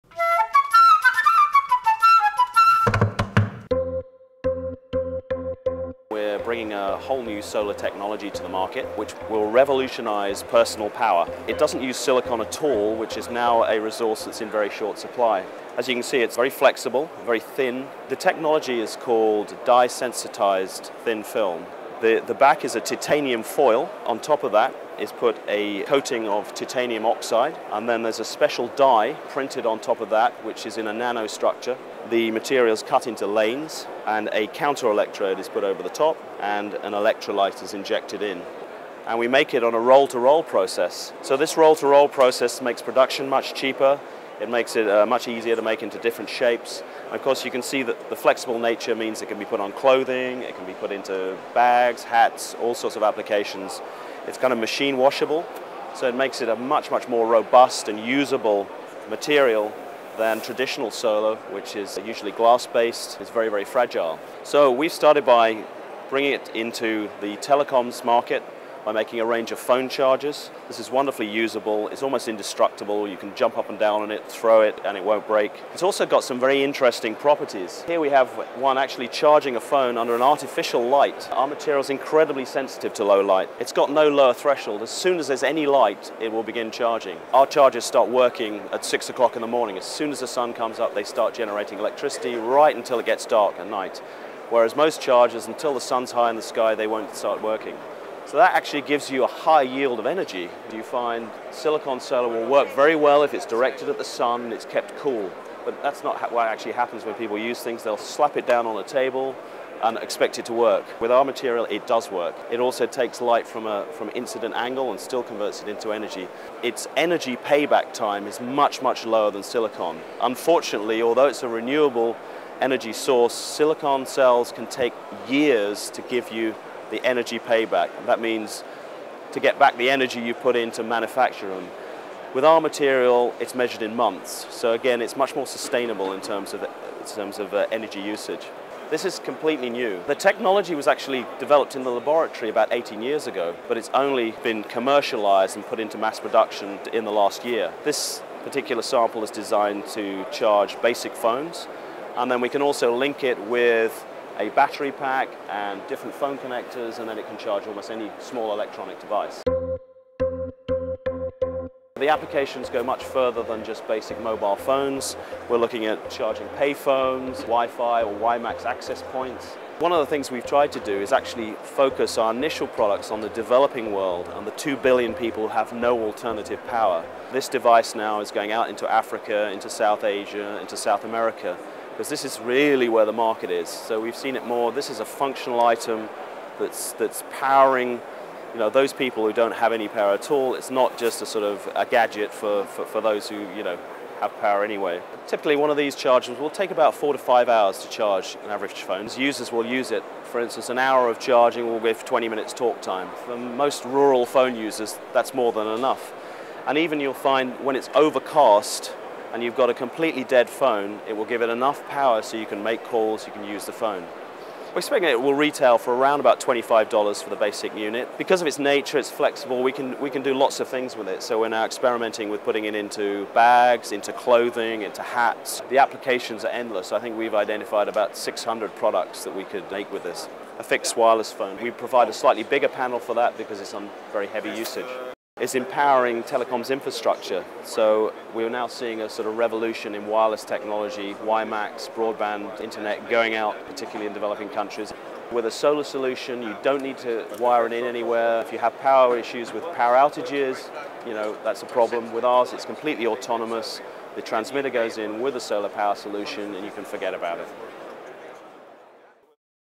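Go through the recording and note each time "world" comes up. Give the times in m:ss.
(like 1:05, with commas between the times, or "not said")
2:53.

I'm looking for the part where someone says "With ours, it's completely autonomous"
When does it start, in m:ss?
4:12.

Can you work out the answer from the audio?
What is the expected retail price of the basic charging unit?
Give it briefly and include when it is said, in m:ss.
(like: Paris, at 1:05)
$25, at 3:36.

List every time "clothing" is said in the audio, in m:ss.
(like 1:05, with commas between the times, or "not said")
0:49, 3:44.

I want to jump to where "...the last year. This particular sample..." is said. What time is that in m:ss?
2:27.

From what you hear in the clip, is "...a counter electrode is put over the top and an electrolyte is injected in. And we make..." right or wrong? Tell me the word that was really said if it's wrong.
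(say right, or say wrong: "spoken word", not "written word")
right.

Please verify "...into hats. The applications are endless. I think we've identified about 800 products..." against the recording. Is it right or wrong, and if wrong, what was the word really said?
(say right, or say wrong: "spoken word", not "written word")
wrong: "600", not "800".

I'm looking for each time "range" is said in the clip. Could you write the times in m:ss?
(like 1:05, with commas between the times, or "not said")
1:09.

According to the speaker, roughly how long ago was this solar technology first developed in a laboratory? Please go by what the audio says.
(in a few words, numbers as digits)
About 18 years ago.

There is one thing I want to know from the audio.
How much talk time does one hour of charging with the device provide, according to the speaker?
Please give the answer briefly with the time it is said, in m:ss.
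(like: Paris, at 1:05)
20 minutes, at 3:22.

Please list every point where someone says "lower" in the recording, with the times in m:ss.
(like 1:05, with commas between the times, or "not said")
1:24, 1:59.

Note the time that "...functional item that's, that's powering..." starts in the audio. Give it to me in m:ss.
3:05.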